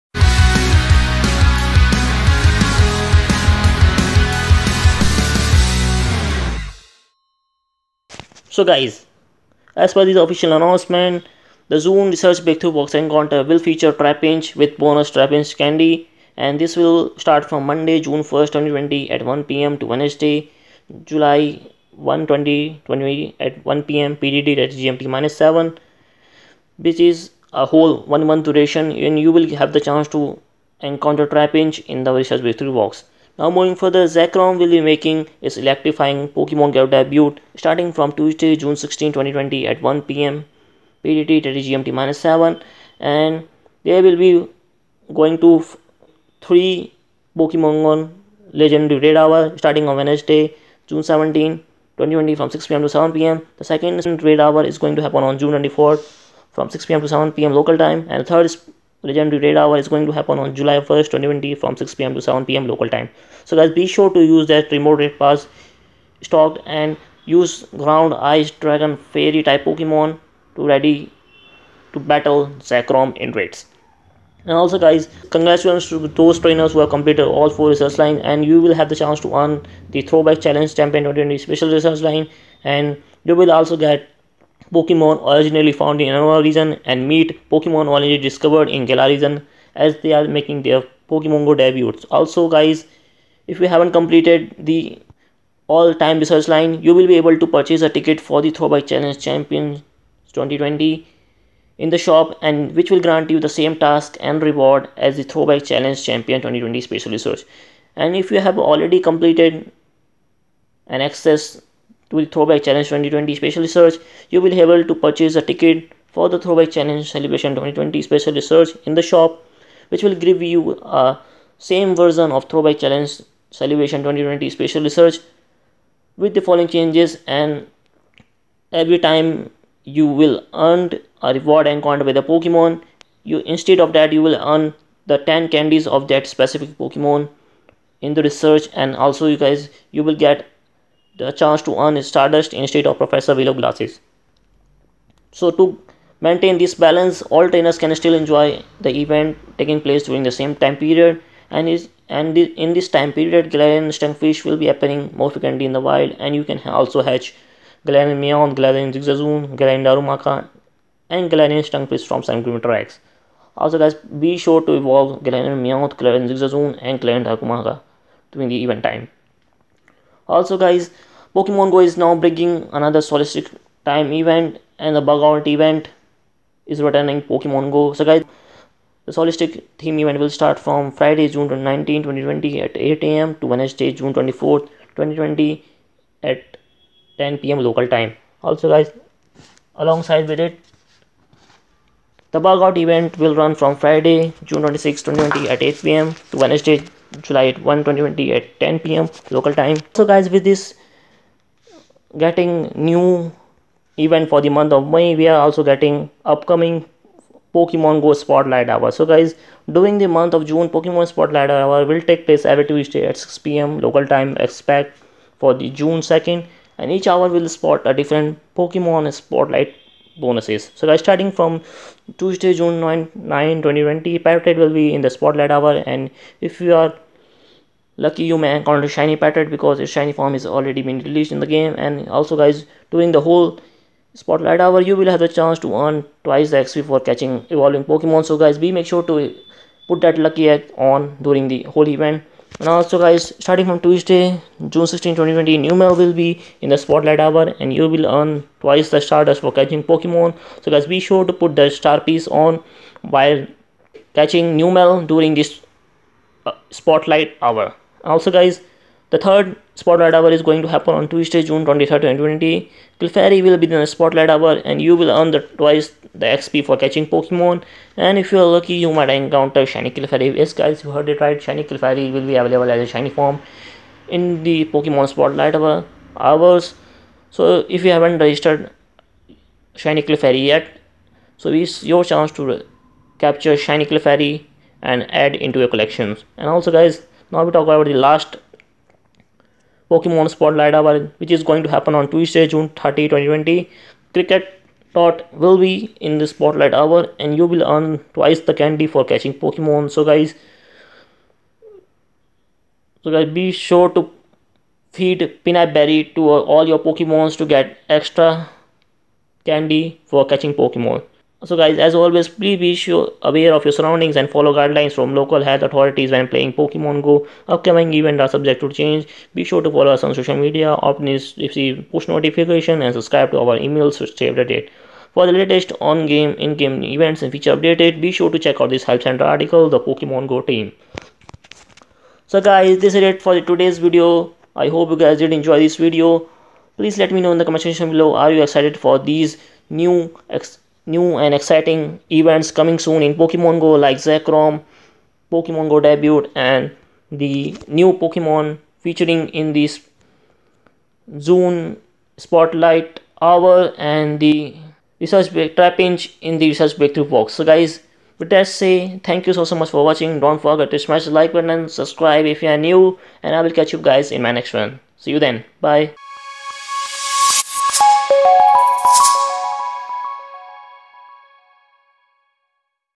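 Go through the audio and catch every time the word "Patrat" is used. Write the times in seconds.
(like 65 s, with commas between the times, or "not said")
224 s, 229 s.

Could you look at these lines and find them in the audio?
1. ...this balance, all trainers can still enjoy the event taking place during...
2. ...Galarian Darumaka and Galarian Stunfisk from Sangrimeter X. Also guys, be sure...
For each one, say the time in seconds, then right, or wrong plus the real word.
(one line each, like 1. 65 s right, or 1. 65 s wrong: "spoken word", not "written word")
1. 146 s right
2. 159 s right.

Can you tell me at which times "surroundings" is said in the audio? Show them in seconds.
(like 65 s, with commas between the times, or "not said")
313 s.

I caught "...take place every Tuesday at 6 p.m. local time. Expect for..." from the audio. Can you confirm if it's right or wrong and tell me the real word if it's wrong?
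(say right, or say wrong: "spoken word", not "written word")
right.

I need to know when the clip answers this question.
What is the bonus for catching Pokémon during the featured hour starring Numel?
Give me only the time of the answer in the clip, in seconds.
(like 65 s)
248 s.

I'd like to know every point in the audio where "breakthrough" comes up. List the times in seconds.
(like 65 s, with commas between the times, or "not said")
12 s, 32 s, 356 s.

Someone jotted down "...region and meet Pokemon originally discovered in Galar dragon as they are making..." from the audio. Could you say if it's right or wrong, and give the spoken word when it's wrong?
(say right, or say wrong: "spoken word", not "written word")
wrong: "region", not "dragon".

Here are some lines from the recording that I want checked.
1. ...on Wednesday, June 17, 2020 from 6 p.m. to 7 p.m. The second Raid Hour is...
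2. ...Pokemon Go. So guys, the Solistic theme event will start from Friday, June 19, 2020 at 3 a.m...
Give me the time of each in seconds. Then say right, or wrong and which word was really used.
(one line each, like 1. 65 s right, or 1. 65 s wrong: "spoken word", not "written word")
1. 49 s right
2. 177 s wrong: "8", not "3".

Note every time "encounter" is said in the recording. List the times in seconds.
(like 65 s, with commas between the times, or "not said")
12 s, 30 s, 131 s, 228 s, 269 s.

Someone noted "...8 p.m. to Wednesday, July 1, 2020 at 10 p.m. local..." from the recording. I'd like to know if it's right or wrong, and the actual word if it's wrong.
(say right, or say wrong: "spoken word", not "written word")
right.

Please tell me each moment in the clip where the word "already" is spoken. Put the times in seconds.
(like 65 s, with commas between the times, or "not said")
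108 s, 230 s.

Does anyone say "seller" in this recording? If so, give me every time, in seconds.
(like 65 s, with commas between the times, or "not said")
not said.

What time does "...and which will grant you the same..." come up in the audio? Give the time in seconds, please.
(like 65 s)
102 s.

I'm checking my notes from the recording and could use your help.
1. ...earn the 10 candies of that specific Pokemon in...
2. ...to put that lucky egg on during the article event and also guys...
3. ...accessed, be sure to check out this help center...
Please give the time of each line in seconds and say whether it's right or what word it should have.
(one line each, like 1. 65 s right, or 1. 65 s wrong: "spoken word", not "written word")
1. 134 s right
2. 239 s wrong: "whole", not "article"
3. 327 s wrong: "updated", not "accessed".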